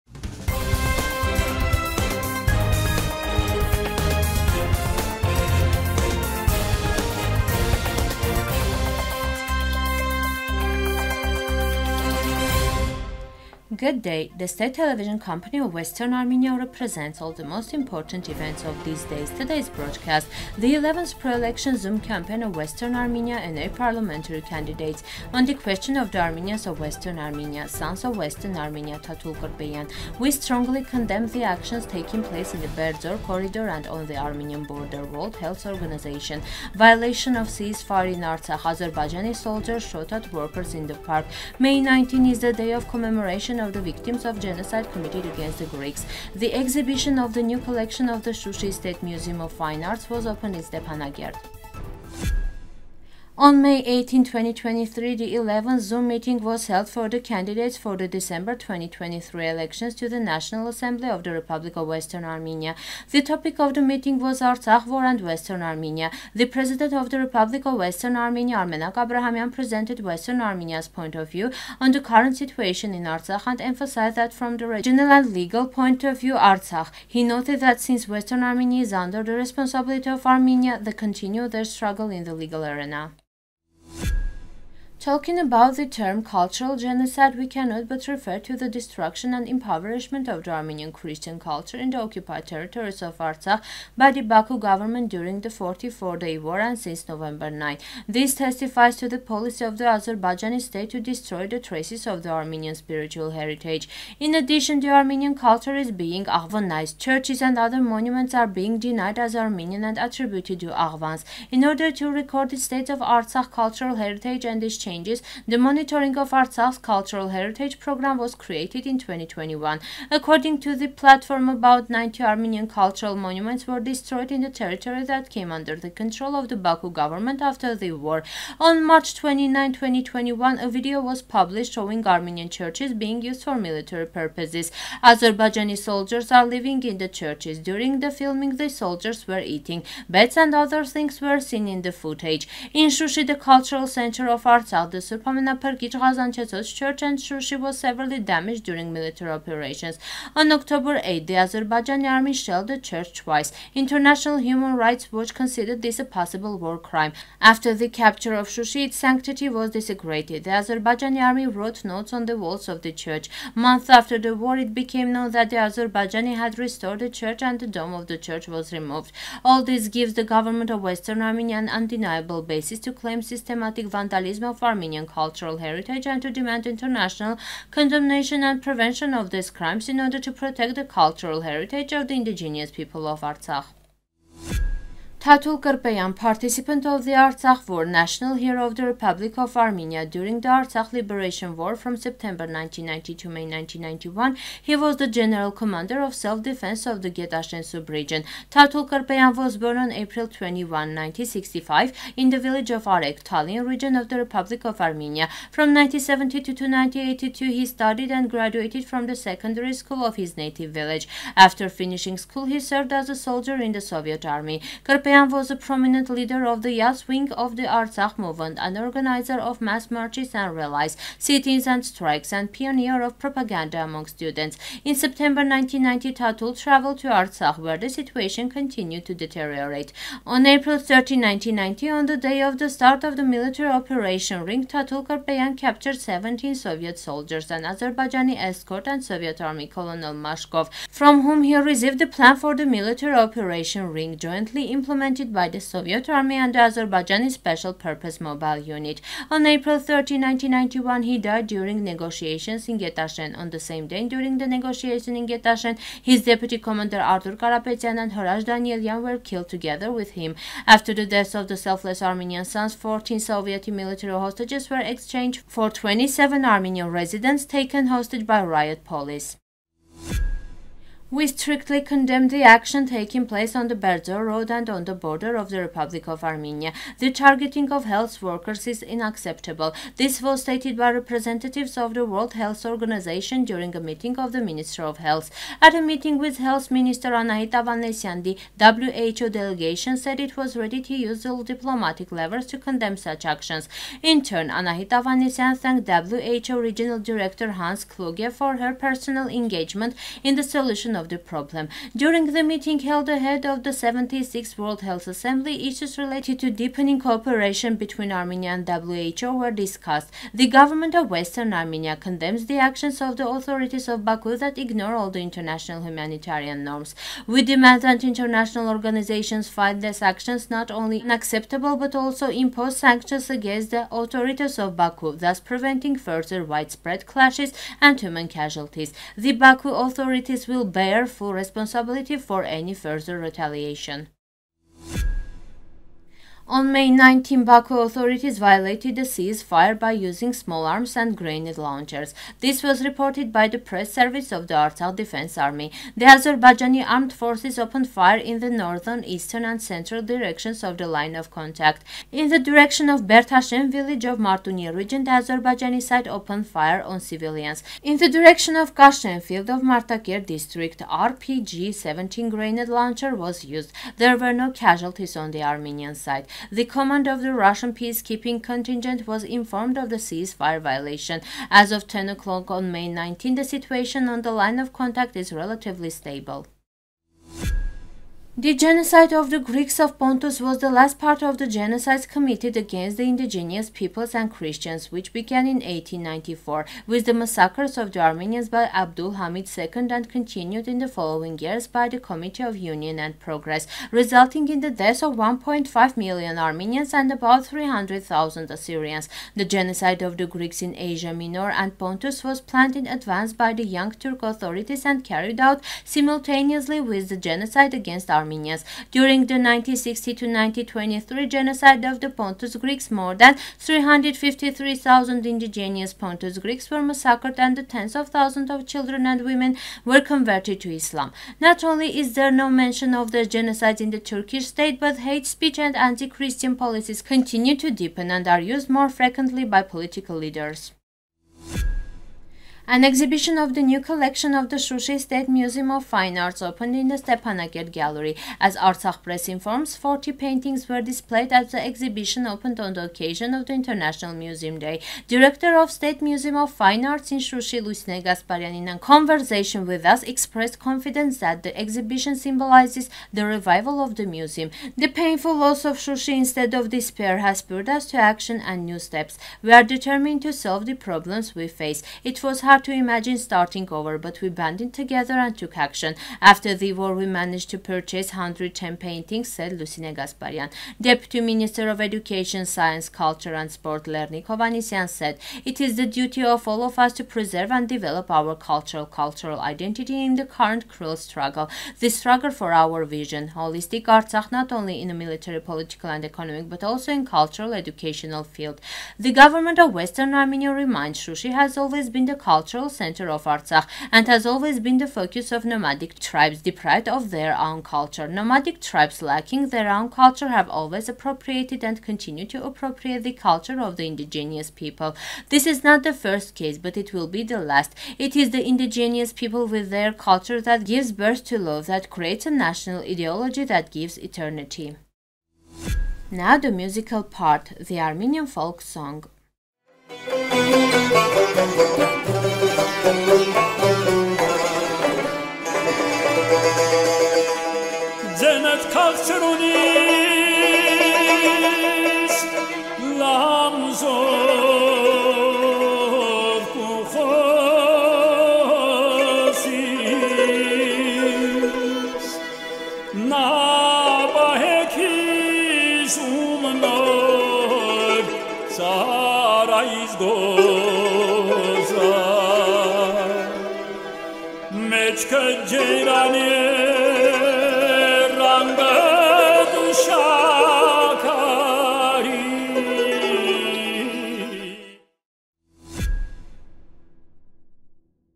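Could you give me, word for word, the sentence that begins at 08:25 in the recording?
This is not the first case, but it will be the last.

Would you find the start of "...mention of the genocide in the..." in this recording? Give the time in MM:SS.
07:02.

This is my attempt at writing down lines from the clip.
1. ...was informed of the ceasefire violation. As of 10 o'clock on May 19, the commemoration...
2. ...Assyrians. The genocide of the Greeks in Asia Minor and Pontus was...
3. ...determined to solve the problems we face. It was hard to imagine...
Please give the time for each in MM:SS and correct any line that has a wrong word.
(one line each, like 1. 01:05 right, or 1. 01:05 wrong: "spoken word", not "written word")
1. 06:09 wrong: "situation", not "commemoration"
2. 06:38 right
3. 07:39 right.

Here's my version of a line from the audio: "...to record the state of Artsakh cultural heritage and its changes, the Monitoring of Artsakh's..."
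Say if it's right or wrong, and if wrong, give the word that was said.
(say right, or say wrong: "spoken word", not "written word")
right.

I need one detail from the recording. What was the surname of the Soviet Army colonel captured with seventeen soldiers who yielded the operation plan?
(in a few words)
Mashkov.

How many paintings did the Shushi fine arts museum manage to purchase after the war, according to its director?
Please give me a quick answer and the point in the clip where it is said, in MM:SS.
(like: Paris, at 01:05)
110, at 07:48.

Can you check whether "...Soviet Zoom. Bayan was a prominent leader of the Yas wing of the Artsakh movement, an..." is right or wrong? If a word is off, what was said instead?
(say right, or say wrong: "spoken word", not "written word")
wrong: "Army", not "Zoom".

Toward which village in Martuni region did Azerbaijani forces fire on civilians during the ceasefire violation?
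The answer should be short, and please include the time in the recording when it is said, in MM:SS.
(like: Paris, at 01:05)
Bertashen, at 05:53.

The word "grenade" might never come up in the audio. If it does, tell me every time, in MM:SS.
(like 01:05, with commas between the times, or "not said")
05:41, 06:02.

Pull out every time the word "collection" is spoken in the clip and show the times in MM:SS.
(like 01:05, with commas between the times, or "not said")
00:47, 07:13.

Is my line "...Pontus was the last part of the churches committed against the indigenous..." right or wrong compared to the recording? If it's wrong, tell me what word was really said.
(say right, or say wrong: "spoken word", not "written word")
wrong: "genocides", not "churches".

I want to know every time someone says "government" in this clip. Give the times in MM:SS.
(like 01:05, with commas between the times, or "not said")
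01:34, 02:07, 02:50, 05:10, 08:09.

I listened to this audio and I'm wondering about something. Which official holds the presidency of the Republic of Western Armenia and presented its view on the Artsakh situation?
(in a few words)
Armenak Abrahamian.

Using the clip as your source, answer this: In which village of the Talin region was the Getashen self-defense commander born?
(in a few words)
Arek.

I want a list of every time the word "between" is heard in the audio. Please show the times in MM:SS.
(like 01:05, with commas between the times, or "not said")
05:07.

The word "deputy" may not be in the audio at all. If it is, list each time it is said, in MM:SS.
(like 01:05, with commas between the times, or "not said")
04:16, 07:50.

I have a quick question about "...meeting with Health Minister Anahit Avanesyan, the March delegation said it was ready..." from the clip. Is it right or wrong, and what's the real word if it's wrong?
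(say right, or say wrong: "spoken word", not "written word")
wrong: "WHO", not "March".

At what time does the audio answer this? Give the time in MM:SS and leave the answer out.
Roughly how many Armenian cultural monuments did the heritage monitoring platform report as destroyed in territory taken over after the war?
02:01.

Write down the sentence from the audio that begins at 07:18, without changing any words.
As Artsakh Press informs, 40 paintings were displayed at the exhibition opened on the occasion of the International Museum Day.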